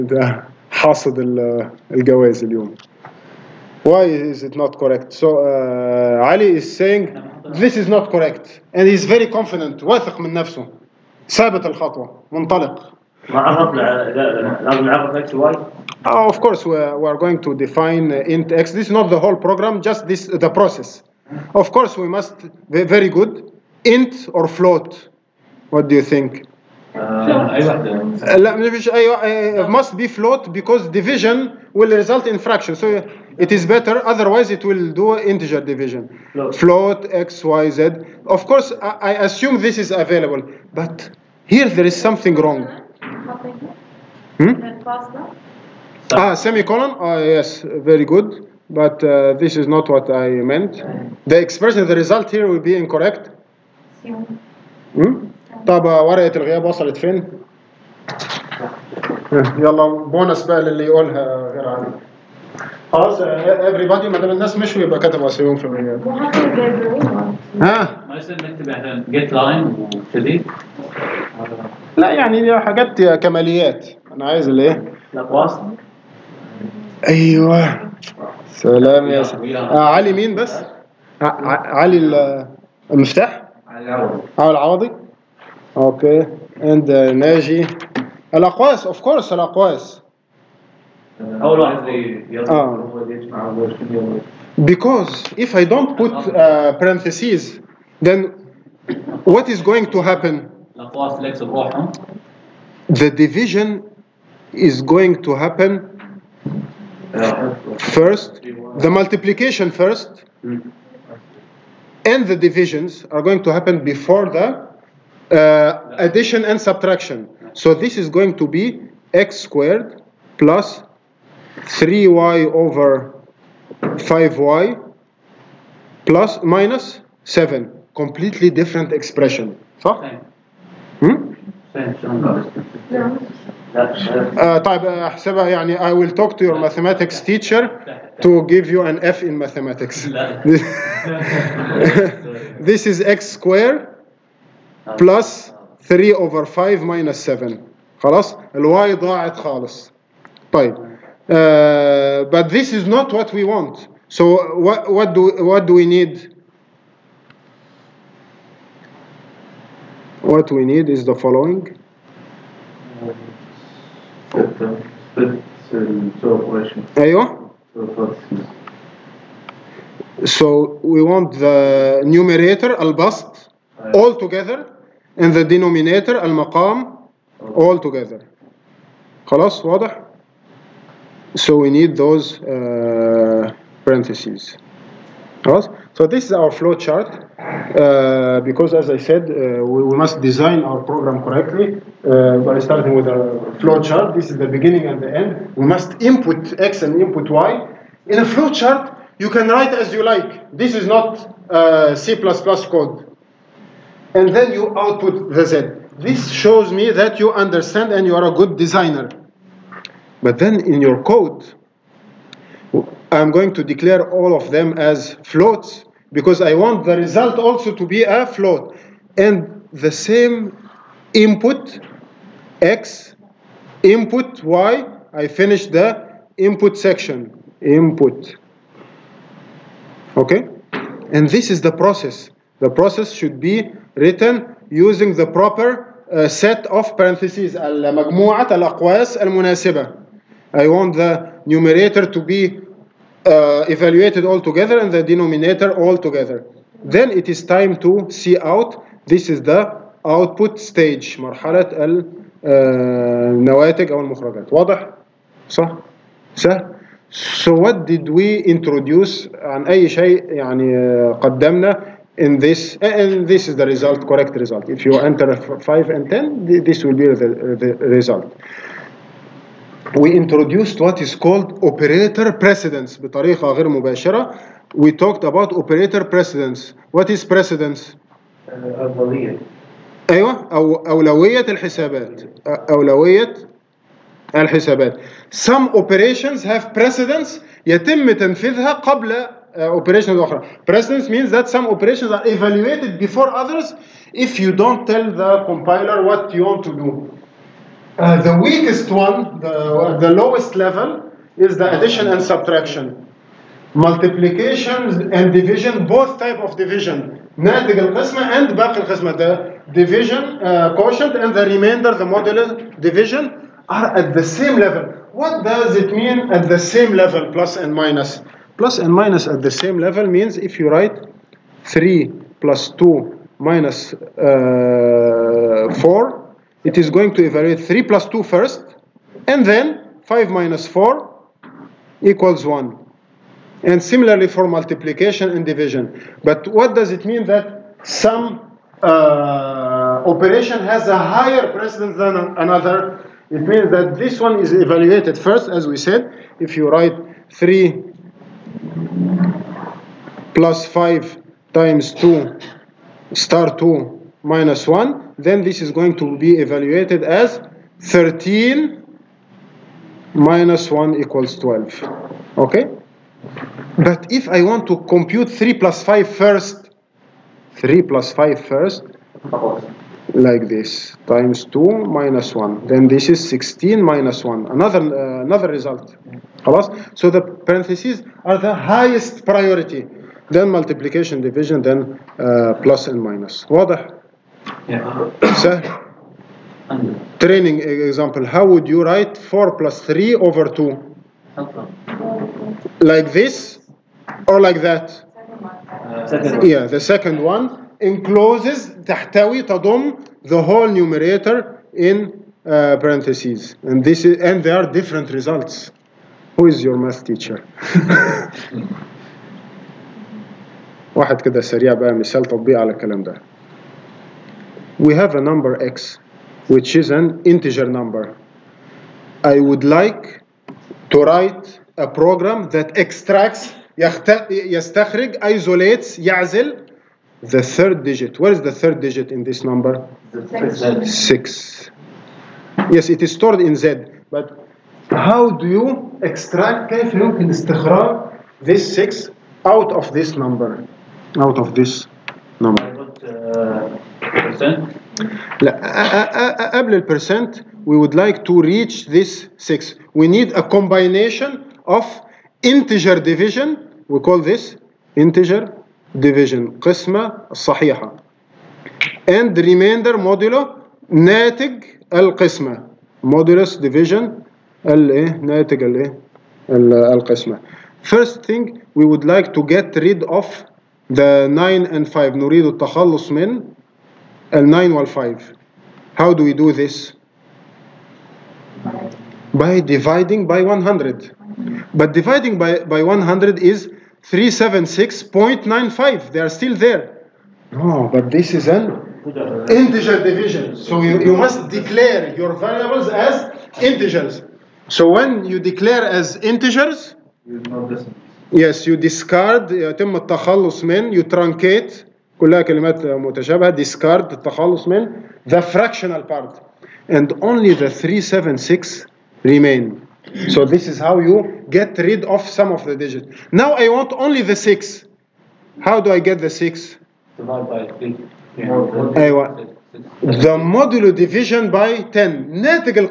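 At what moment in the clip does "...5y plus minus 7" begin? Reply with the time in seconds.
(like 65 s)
123 s.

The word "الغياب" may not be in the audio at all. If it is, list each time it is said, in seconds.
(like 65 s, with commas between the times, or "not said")
56 s, 65 s.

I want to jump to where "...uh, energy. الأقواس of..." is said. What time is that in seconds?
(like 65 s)
86 s.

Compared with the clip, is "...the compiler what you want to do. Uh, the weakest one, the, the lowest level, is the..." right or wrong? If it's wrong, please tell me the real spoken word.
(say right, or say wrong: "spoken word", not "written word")
right.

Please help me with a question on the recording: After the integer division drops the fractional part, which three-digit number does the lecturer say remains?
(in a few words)
376.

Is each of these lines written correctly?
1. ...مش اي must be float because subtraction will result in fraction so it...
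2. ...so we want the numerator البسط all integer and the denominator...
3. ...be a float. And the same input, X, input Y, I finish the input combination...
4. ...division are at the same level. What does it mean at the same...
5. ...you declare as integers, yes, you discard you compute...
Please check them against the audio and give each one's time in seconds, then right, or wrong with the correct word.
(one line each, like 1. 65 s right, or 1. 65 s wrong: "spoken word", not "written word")
1. 28 s wrong: "division", not "subtraction"
2. 170 s wrong: "together", not "integer"
3. 217 s wrong: "section", not "combination"
4. 312 s right
5. 495 s wrong: "truncate", not "compute".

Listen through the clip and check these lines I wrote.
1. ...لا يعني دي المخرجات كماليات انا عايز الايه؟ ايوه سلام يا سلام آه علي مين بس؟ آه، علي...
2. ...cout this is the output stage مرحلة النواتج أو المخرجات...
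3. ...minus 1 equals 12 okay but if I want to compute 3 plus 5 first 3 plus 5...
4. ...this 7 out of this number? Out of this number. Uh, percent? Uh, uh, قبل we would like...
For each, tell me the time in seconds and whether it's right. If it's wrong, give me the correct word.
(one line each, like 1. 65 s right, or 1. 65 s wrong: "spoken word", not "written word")
1. 71 s wrong: "حاجات", not "المخرجات"
2. 248 s right
3. 360 s right
4. 438 s wrong: "6", not "7".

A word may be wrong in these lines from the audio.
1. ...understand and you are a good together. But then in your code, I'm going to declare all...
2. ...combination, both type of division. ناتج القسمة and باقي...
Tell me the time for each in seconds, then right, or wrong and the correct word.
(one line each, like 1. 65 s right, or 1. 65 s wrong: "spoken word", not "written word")
1. 207 s wrong: "designer", not "together"
2. 305 s wrong: "division", not "combination".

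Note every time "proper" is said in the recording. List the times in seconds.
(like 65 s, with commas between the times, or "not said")
235 s.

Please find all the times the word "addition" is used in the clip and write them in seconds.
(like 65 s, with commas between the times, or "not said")
115 s, 301 s.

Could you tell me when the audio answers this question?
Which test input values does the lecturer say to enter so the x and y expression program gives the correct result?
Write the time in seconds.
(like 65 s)
265 s.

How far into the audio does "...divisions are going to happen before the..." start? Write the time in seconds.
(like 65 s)
112 s.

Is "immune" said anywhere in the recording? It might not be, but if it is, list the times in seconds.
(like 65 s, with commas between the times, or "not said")
not said.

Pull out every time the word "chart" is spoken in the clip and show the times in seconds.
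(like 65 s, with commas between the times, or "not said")
186 s, 193 s, 198 s.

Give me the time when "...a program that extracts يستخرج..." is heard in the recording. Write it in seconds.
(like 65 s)
421 s.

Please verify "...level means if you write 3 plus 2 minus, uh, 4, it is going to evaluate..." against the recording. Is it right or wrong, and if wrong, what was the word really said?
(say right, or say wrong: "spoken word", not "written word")
right.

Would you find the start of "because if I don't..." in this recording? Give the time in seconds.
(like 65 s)
94 s.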